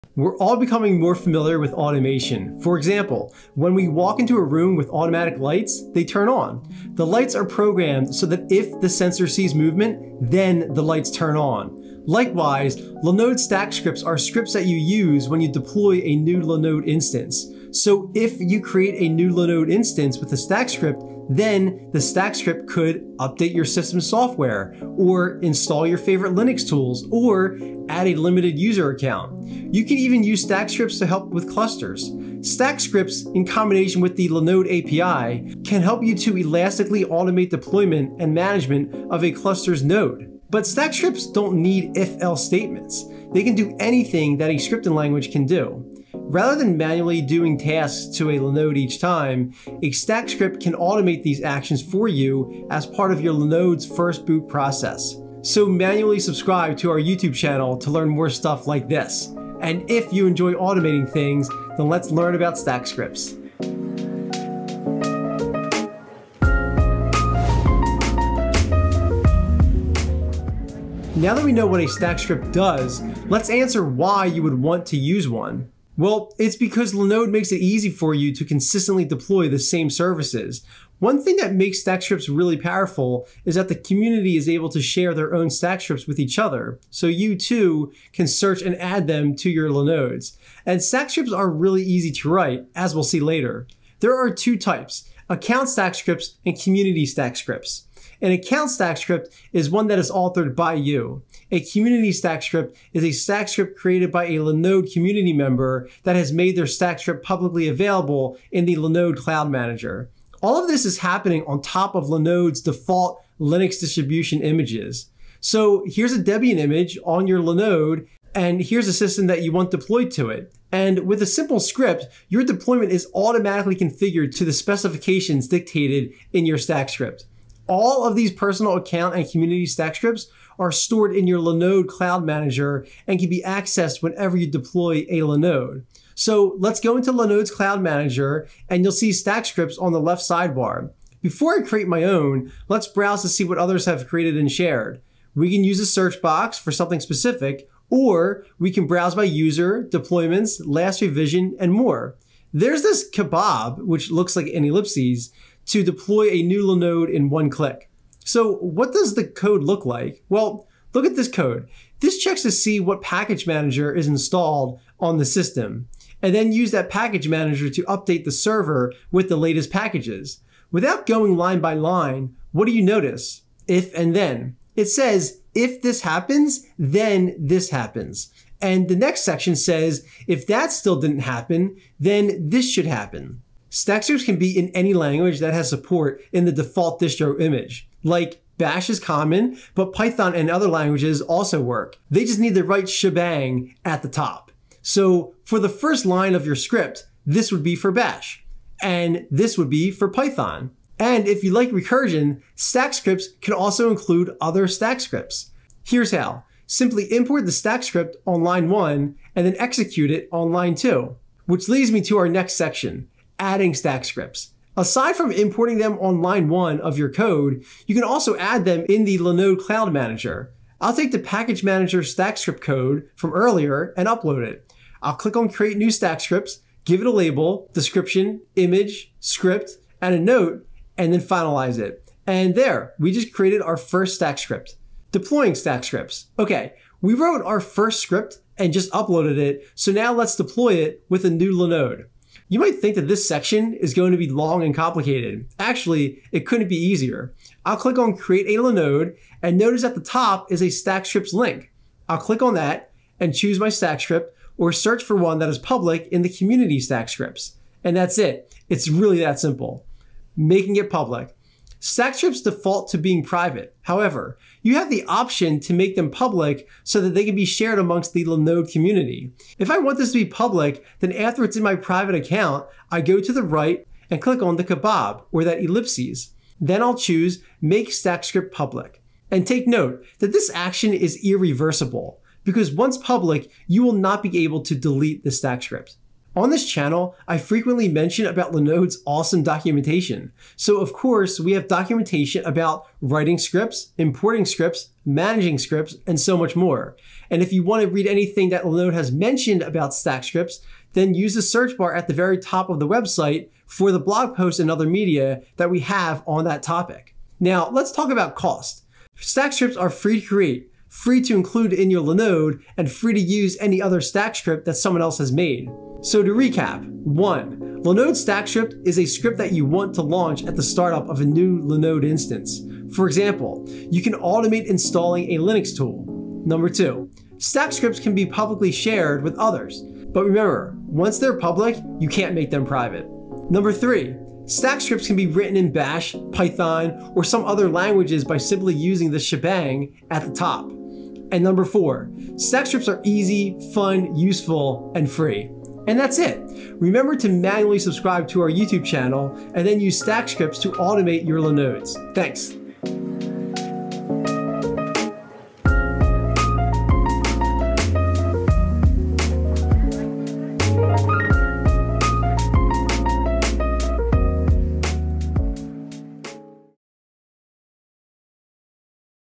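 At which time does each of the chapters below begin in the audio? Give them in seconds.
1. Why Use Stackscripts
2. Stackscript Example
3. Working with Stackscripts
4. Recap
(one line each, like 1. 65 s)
1. 71 s
2. 160 s
3. 214 s
4. 317 s.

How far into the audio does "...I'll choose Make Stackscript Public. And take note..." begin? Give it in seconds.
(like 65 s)
276 s.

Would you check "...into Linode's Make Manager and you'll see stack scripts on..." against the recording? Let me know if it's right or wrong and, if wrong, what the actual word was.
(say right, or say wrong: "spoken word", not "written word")
wrong: "Cloud", not "Make".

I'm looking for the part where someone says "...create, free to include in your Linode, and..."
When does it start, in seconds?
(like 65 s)
310 s.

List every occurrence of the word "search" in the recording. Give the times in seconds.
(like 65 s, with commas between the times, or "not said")
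88 s, 145 s, 254 s, 301 s.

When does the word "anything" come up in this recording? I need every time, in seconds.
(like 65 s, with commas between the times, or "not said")
43 s, 298 s.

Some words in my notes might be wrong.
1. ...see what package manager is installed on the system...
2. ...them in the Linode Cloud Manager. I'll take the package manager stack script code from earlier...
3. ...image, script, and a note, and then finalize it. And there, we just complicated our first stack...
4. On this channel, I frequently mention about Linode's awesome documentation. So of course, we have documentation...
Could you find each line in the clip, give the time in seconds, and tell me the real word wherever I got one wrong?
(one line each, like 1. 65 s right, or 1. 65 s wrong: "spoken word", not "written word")
1. 162 s right
2. 218 s right
3. 228 s wrong: "created", not "complicated"
4. 286 s right.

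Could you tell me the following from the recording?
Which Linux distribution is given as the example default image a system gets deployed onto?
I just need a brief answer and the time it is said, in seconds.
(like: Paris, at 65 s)
Debian, at 116 s.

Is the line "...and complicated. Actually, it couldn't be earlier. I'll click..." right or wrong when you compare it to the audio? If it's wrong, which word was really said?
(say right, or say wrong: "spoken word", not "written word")
wrong: "easier", not "earlier".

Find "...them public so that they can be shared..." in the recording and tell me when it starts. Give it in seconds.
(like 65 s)
265 s.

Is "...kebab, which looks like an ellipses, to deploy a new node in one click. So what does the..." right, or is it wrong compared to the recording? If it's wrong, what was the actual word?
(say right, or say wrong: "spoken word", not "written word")
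right.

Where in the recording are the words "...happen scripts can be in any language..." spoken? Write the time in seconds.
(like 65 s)
182 s.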